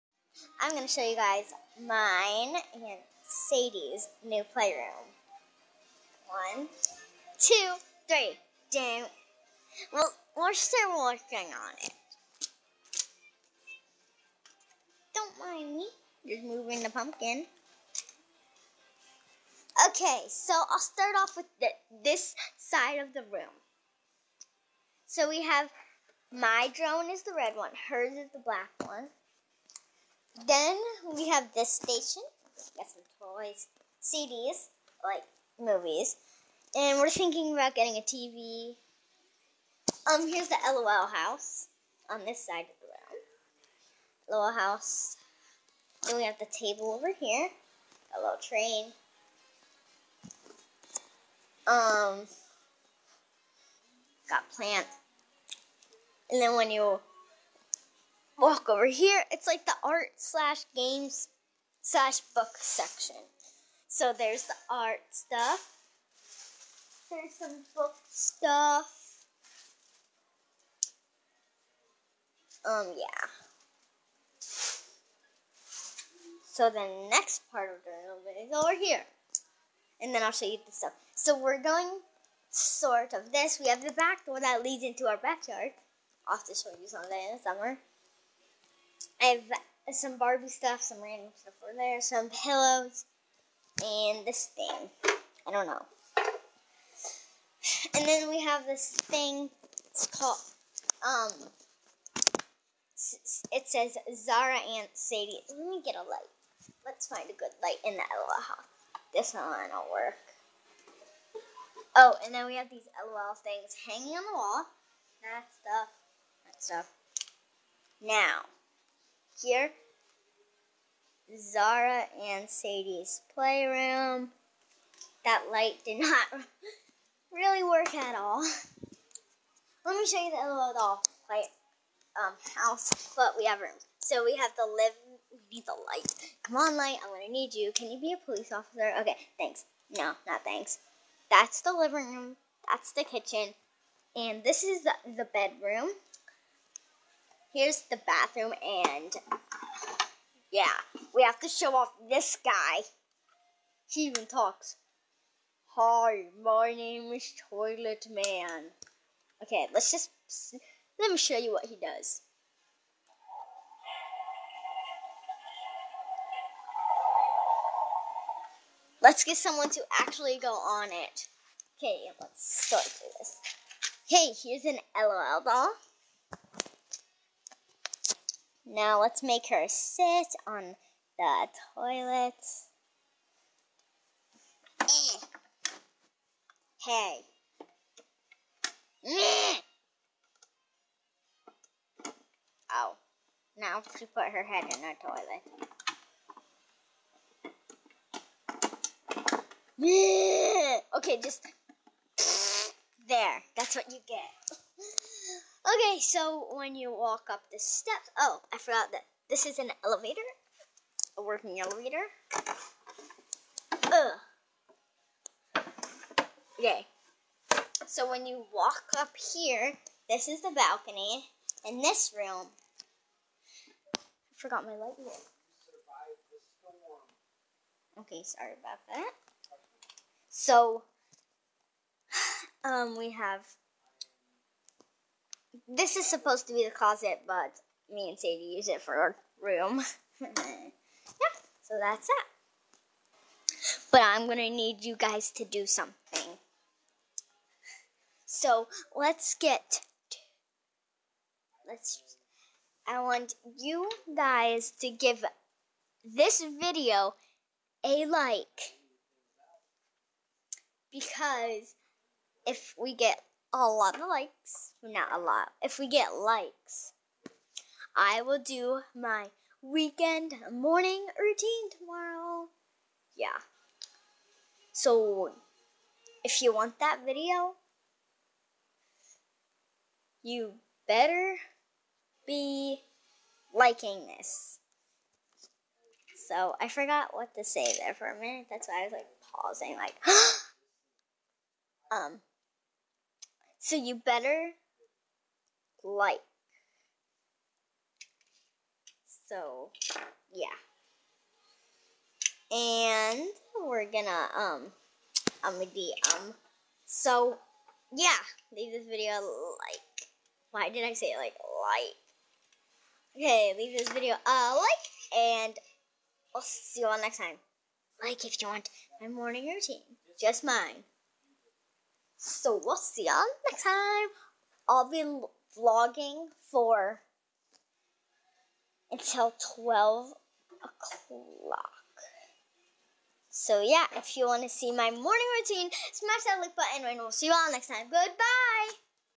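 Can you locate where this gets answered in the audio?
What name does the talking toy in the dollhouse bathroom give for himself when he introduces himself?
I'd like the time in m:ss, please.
2:37.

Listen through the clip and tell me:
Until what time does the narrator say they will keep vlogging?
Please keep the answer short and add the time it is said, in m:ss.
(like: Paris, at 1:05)
12 o'clock, at 5:29.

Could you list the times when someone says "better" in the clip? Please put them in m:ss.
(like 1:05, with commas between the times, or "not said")
4:40, 4:53.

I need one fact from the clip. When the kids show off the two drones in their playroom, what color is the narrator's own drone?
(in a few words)
Red.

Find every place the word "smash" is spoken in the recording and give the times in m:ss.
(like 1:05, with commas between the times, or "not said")
5:35.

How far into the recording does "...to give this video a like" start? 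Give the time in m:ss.
4:14.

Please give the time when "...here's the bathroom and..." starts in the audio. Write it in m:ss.
2:27.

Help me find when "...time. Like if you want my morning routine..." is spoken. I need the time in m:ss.
5:17.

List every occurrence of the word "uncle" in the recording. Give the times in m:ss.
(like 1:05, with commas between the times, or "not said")
not said.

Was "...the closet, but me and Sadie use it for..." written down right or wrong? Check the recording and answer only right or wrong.
right.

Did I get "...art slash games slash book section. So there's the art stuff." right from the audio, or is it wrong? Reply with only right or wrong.
right.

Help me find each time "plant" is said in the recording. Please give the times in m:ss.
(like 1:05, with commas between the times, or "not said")
0:54.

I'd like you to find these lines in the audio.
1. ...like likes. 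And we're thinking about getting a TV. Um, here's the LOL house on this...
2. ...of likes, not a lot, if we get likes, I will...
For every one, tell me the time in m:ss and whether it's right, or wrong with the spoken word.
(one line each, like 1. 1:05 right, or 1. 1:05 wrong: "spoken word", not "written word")
1. 0:35 wrong: "movies", not "likes"
2. 4:23 right.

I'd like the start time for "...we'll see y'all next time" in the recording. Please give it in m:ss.
5:22.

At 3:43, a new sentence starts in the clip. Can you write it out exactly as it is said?
I forgot my light Okay, sorry about that.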